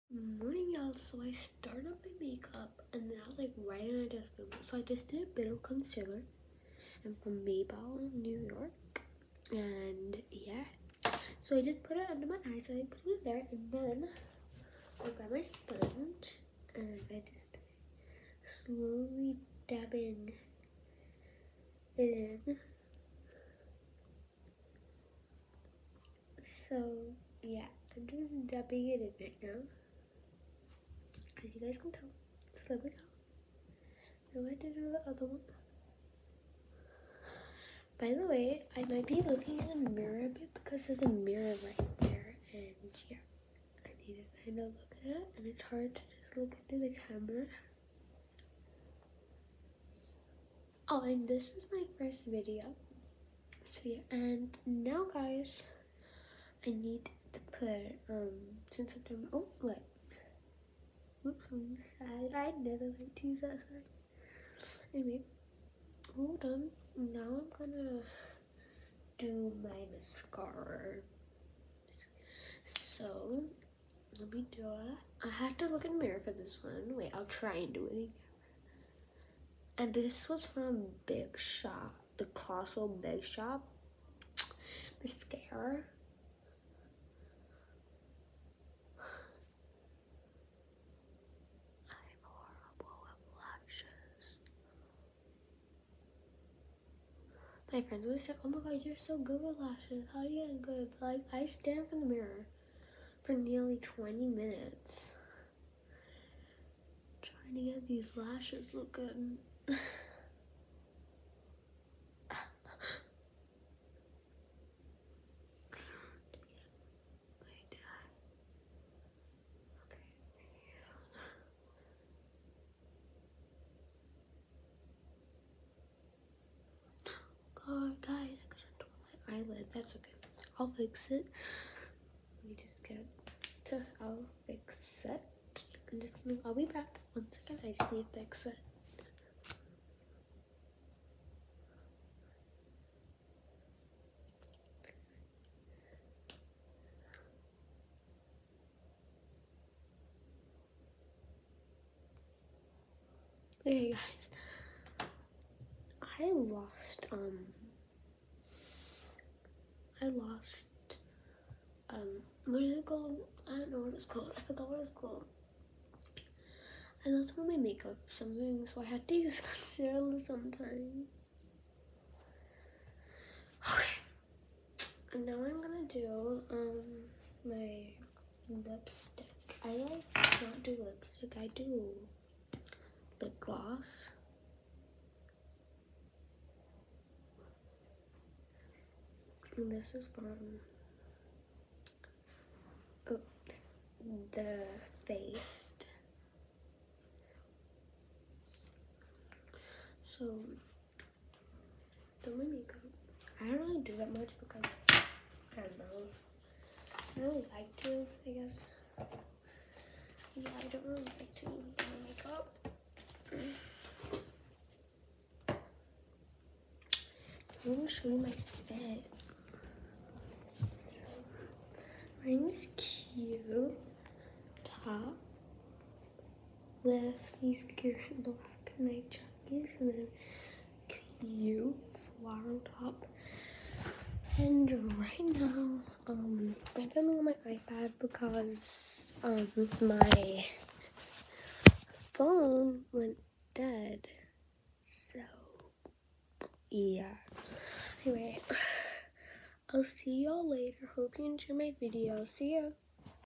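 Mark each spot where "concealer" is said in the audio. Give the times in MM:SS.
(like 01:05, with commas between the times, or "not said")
00:05, 02:49.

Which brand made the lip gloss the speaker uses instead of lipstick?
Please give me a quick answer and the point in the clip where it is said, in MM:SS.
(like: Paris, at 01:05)
Too Faced, at 03:14.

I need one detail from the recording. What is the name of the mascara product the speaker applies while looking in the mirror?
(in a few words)
Colossal Big Shot.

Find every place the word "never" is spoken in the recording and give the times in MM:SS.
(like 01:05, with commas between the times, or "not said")
01:02.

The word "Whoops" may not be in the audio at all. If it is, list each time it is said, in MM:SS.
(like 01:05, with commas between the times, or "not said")
01:01.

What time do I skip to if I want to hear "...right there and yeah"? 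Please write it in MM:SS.
00:41.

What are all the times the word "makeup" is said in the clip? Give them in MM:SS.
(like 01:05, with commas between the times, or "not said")
00:02, 02:47, 03:22, 03:32.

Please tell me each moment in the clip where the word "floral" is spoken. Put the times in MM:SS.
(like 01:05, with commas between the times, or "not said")
03:52.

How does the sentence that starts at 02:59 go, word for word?
I like not do lipstick, I do lip gloss.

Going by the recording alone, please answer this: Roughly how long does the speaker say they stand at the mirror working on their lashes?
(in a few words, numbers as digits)
20 minutes.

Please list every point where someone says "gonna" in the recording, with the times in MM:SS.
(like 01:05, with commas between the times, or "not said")
01:07, 02:16, 02:55, 03:37.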